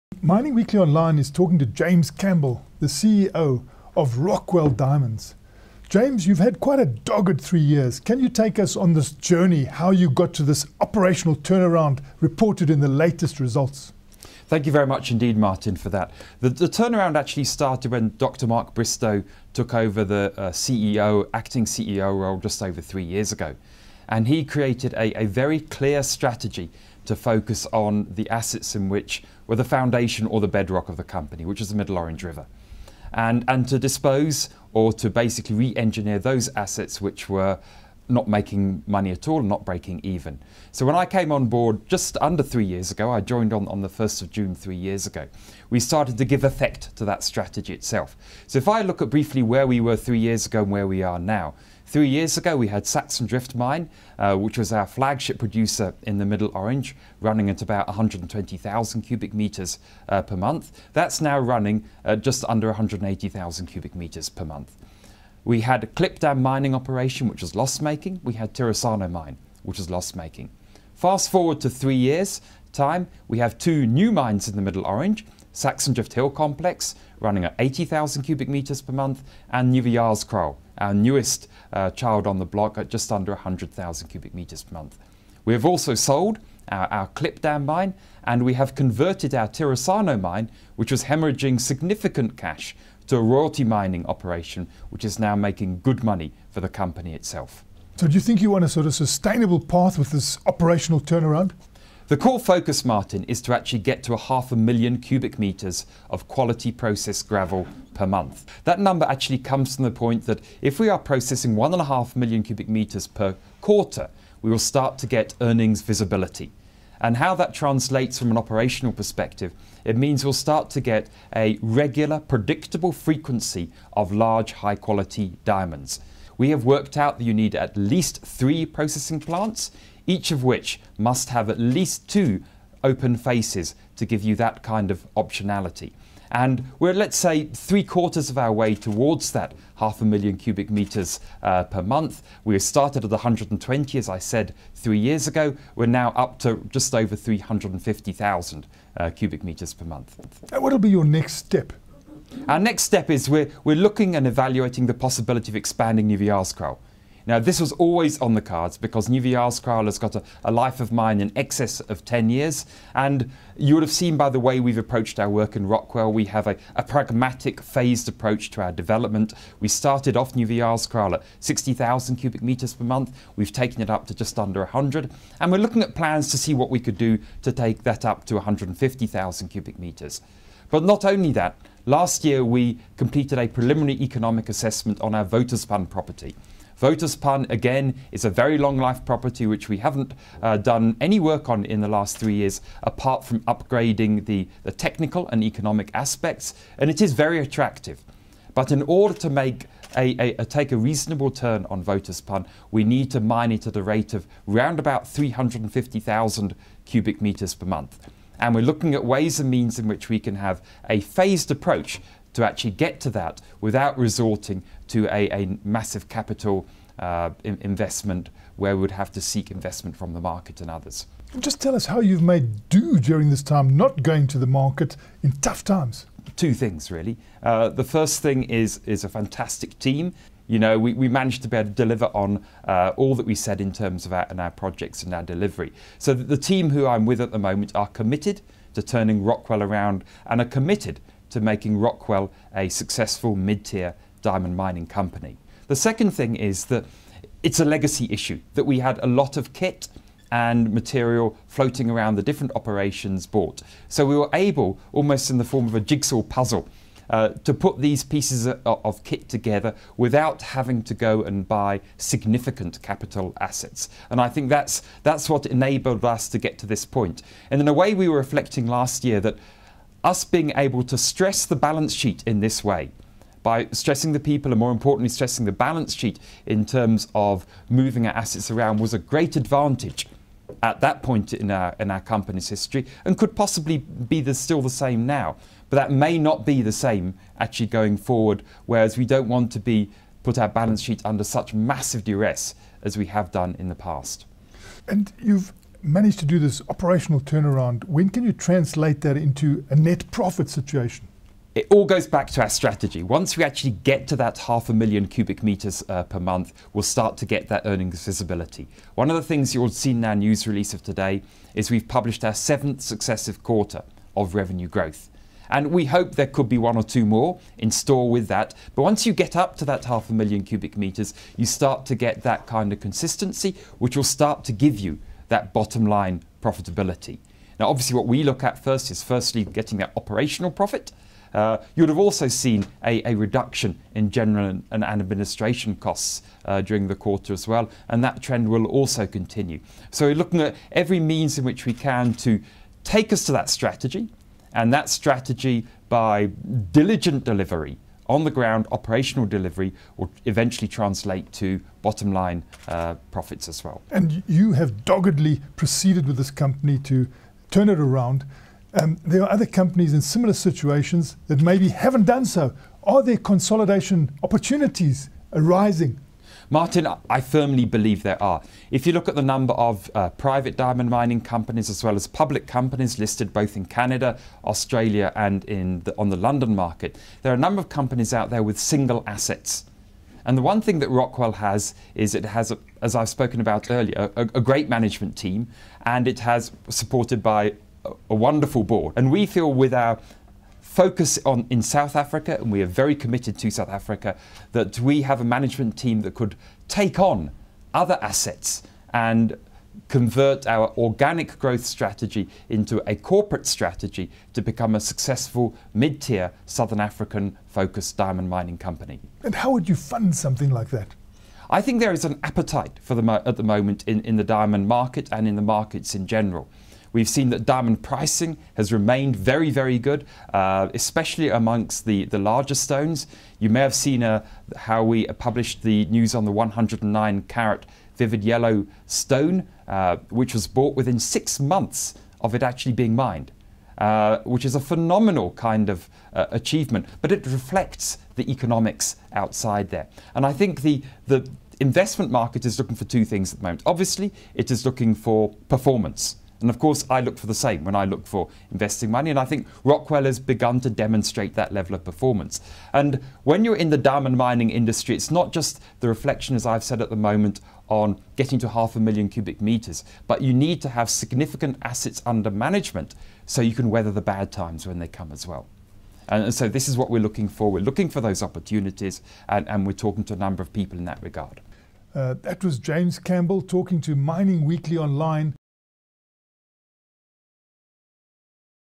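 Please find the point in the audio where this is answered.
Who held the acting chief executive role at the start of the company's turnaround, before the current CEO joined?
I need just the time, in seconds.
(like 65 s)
18 s.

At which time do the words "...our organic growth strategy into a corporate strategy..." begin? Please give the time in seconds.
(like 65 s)
400 s.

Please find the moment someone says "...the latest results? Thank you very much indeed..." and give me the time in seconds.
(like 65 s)
12 s.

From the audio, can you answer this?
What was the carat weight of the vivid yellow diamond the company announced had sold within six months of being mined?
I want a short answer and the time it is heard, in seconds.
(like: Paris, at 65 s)
109 carats, at 426 s.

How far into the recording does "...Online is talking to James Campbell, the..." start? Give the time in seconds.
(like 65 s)
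0 s.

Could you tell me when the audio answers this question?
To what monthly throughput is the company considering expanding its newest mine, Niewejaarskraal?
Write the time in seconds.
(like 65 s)
178 s.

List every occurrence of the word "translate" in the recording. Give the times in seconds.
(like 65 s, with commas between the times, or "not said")
117 s, 298 s, 350 s.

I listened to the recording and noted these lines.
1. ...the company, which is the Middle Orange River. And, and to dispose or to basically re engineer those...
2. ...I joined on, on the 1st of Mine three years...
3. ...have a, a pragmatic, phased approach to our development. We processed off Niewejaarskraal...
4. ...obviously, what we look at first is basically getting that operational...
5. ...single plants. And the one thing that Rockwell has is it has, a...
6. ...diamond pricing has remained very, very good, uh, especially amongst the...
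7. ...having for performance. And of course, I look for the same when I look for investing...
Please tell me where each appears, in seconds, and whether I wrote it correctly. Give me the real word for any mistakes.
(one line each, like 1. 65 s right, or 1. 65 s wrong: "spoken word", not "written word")
1. 30 s right
2. 43 s wrong: "June", not "Mine"
3. 166 s wrong: "started", not "processed"
4. 327 s wrong: "firstly", not "basically"
5. 378 s wrong: "assets", not "plants"
6. 417 s right
7. 444 s wrong: "looking", not "having".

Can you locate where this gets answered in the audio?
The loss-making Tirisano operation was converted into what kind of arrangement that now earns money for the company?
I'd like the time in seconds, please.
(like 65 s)
93 s.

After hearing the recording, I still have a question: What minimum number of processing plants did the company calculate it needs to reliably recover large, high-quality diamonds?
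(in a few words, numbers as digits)
3.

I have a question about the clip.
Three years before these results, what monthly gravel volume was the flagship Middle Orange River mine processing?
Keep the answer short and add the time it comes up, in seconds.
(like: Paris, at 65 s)
120,000 cubic meters, at 57 s.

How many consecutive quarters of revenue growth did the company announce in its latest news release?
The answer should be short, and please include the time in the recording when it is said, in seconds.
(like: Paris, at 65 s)
7, at 312 s.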